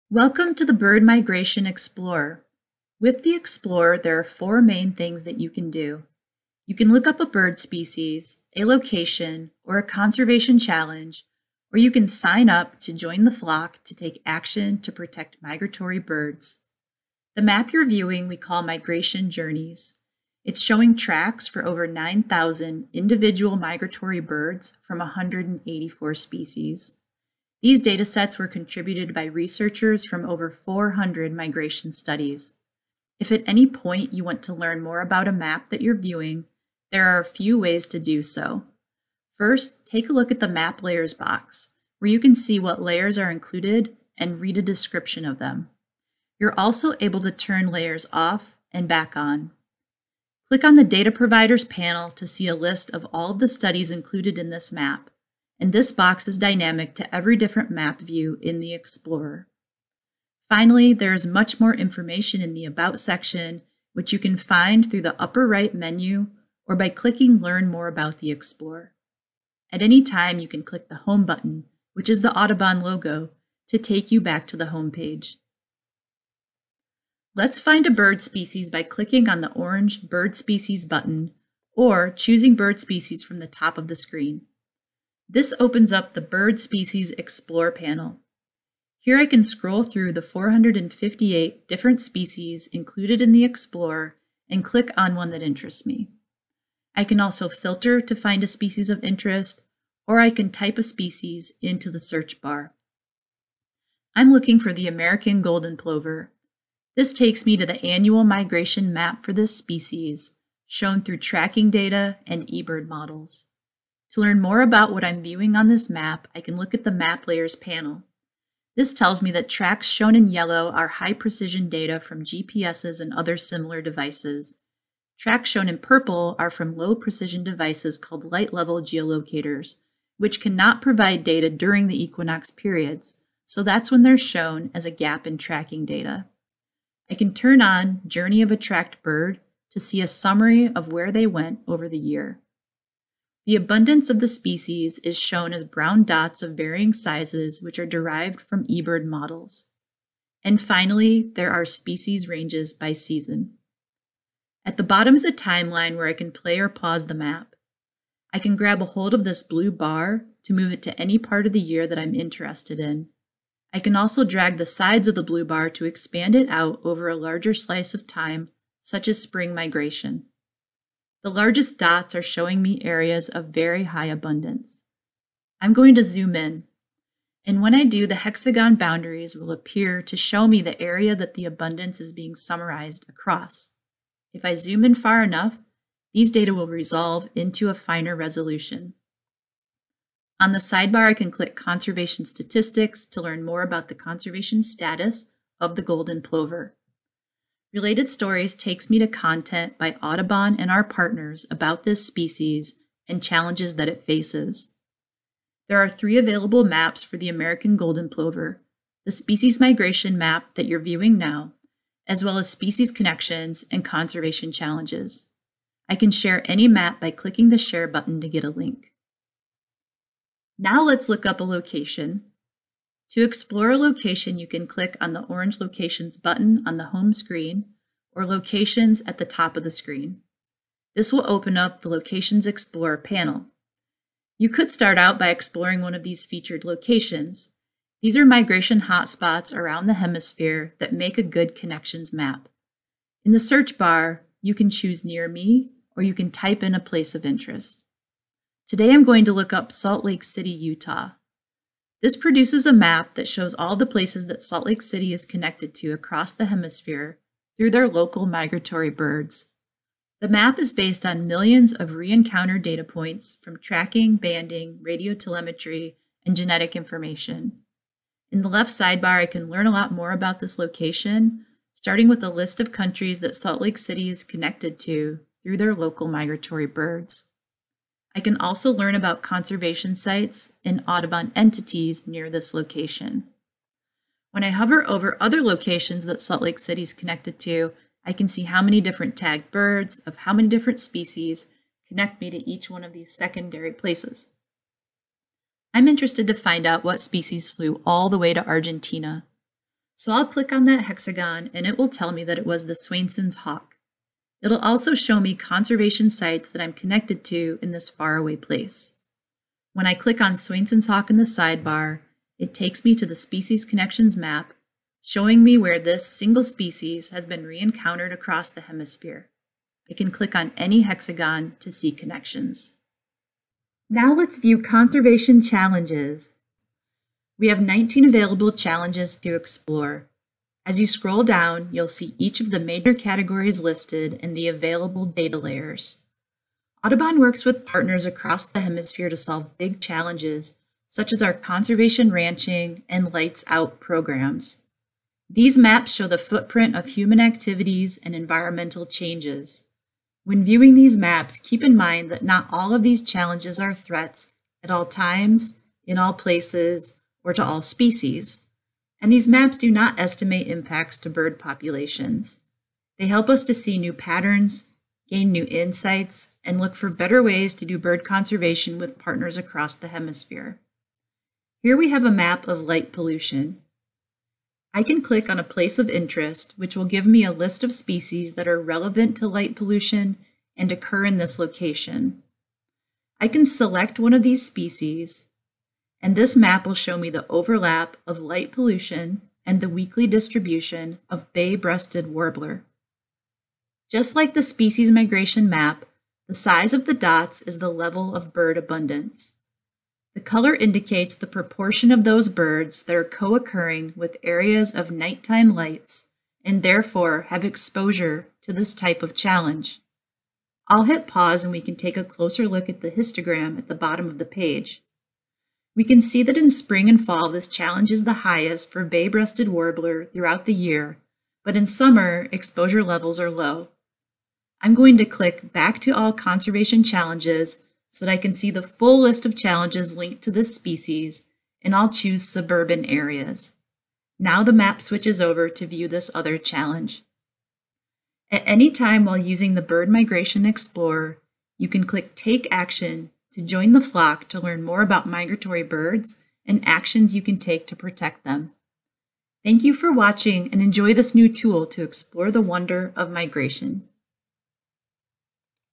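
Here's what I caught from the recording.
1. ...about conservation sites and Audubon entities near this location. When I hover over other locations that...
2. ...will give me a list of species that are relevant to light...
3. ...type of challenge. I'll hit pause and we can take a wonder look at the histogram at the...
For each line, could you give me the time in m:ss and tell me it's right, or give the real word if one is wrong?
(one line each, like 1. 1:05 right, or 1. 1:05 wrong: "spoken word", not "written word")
1. 4:38 right
2. 6:16 right
3. 6:48 wrong: "closer", not "wonder".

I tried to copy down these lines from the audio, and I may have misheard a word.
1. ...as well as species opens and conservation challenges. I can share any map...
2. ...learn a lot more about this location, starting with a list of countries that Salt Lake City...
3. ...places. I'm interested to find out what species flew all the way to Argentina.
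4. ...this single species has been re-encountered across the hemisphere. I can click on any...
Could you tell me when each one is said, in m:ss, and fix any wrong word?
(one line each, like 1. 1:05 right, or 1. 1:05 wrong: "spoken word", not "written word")
1. 3:32 wrong: "connections", not "opens"
2. 4:29 right
3. 4:53 right
4. 5:15 right.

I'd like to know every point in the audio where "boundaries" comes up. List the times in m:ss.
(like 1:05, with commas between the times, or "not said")
2:58.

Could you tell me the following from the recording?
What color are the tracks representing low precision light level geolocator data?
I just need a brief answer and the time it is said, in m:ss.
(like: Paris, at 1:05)
Purple, at 2:05.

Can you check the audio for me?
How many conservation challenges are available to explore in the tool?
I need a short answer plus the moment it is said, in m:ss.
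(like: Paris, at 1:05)
19, at 5:27.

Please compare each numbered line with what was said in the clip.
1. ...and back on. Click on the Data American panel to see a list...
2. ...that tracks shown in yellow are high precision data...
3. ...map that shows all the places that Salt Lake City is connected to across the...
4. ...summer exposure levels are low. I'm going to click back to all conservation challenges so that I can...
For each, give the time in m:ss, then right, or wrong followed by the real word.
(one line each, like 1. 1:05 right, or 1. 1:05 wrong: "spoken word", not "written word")
1. 0:48 wrong: "Providers", not "American"
2. 1:59 right
3. 4:12 right
4. 7:01 right.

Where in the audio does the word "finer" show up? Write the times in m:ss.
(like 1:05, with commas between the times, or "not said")
3:07.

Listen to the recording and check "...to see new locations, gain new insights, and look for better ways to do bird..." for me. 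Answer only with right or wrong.
wrong.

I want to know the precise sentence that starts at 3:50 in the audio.
This will open up the Locations Explorer panel.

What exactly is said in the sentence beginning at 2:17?
I can turn on Journey of a Tracked Bird to see a summary of where they went over the year.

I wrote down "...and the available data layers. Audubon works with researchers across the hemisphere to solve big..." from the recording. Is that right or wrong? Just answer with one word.
wrong.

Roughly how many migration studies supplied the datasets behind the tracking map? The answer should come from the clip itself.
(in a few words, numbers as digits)
over 400.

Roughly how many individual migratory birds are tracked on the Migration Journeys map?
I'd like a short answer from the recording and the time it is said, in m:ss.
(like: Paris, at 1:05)
over 9,000, at 0:21.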